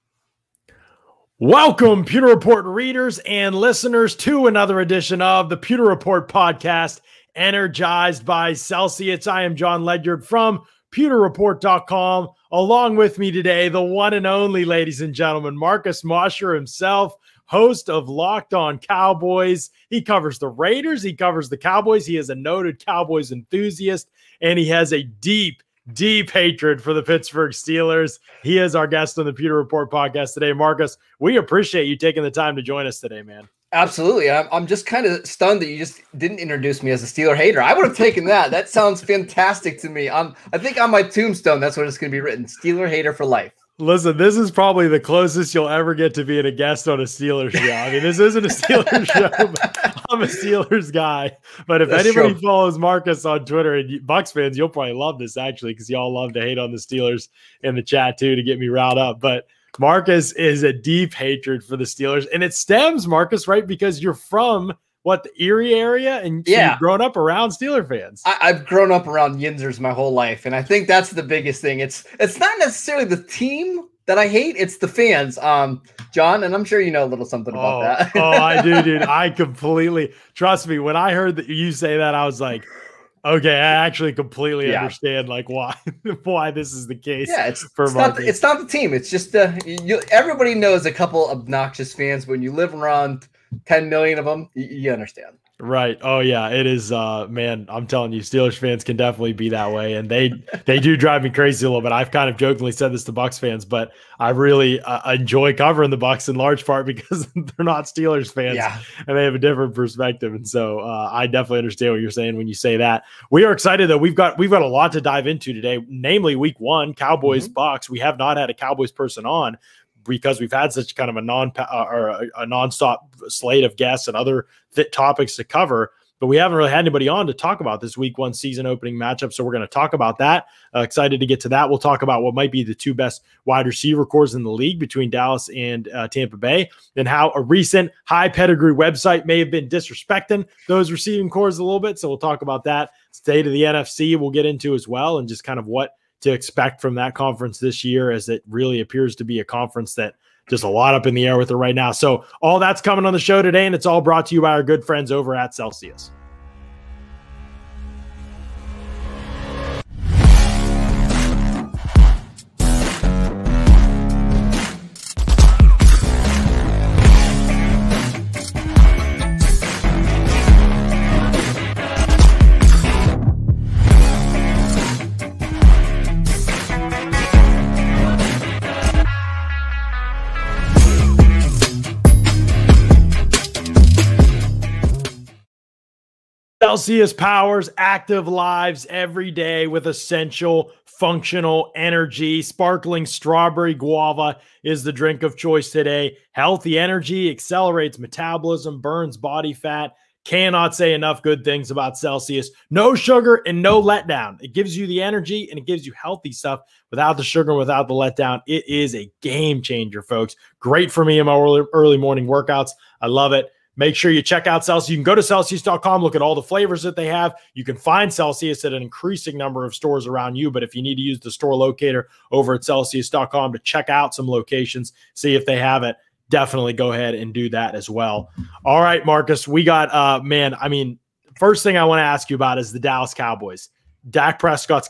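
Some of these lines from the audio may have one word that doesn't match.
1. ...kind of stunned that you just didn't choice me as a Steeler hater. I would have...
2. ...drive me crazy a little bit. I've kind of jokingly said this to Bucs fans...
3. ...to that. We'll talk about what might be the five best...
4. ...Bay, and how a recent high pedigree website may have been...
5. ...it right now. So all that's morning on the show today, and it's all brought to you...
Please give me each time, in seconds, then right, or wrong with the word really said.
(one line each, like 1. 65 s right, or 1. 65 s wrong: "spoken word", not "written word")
1. 34 s wrong: "introduce", not "choice"
2. 100 s right
3. 131 s wrong: "two", not "five"
4. 136 s right
5. 151 s wrong: "coming", not "morning".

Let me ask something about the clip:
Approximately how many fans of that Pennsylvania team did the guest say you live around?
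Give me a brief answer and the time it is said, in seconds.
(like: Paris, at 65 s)
10 million, at 93 s.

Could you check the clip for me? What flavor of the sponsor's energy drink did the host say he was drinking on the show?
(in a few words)
Sparkling strawberry guava.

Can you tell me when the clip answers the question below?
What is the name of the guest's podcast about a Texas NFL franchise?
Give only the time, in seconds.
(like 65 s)
18 s.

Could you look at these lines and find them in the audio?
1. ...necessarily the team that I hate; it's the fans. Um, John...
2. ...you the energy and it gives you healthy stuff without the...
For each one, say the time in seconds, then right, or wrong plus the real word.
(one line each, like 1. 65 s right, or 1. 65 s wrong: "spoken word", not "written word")
1. 72 s right
2. 204 s right.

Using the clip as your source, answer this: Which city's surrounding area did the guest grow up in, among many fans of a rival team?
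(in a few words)
Erie.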